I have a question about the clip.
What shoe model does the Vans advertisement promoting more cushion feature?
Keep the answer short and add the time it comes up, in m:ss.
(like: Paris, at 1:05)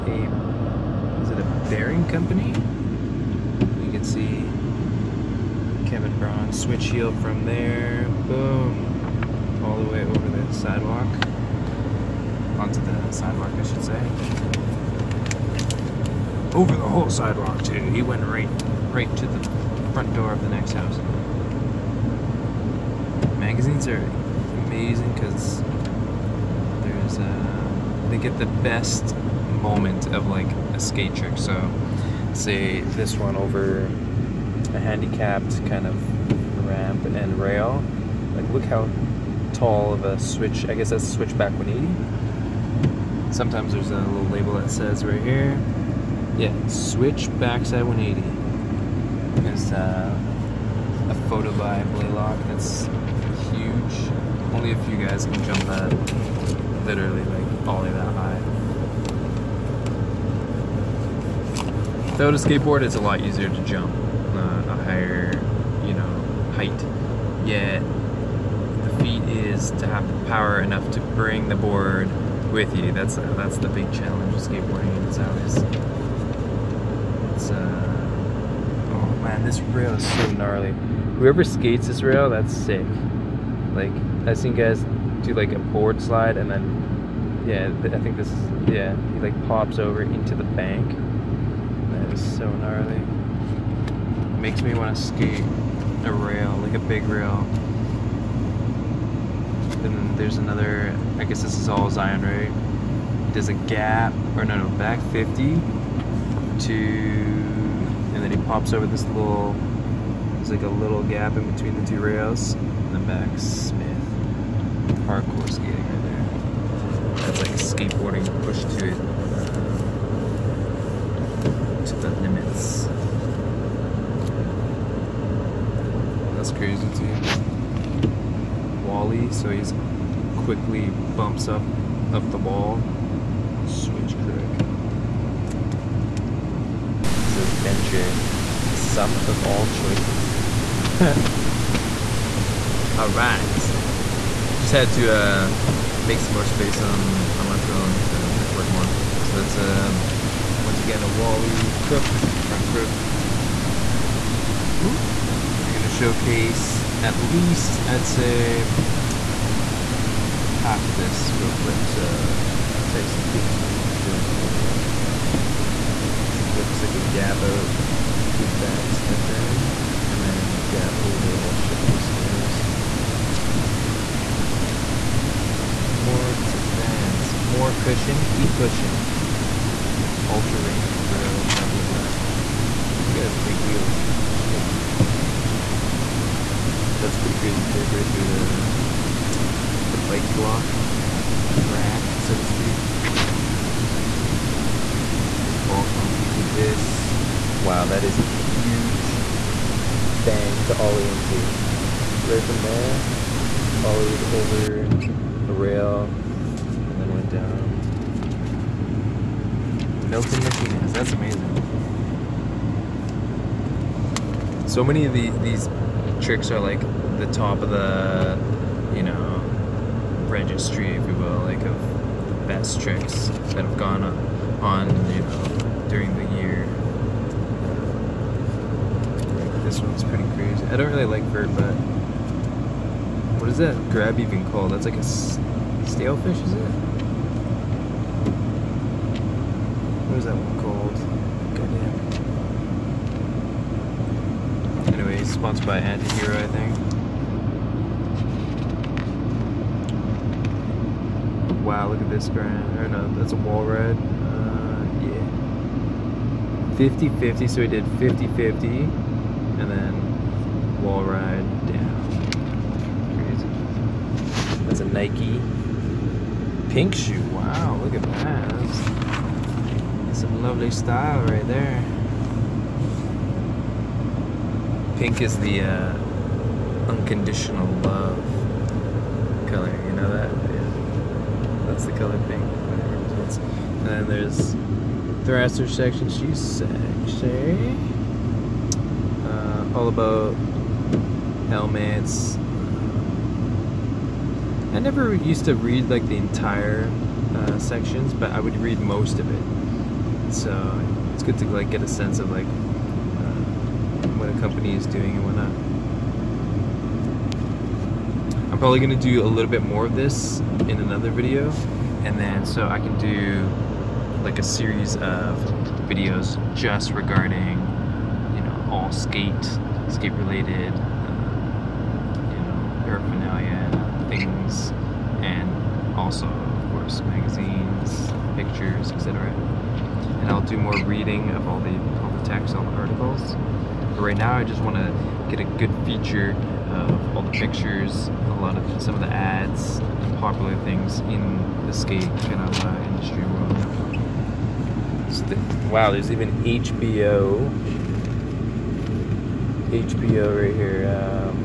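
Ultra Range Pro, at 3:00.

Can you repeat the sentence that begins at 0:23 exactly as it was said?
Magazines are amazing because there's a.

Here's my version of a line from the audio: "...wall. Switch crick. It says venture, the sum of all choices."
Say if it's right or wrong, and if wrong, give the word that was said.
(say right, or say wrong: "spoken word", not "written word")
right.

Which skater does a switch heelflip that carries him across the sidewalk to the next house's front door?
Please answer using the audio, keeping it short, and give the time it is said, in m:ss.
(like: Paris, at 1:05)
Kevin Braun, at 0:05.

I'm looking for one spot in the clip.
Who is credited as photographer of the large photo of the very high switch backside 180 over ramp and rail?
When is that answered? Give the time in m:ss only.
0:51.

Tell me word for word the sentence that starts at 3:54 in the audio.
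That's like a stale fish, is it?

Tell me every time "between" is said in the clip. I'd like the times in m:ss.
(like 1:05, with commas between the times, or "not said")
1:51.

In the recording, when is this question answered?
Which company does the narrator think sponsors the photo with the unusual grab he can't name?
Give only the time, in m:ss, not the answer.
4:05.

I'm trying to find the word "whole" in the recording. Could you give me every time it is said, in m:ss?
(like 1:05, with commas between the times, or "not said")
0:16, 2:51.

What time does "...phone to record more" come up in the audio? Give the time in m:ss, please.
2:27.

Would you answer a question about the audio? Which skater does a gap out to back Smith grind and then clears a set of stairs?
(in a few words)
Tyson Peterson.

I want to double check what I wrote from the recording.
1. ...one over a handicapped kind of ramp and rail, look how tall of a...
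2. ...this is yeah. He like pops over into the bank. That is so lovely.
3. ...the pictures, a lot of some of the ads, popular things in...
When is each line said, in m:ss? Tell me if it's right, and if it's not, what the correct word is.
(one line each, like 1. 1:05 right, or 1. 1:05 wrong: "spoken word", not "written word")
1. 0:33 right
2. 1:28 wrong: "gnarly", not "lovely"
3. 5:37 right.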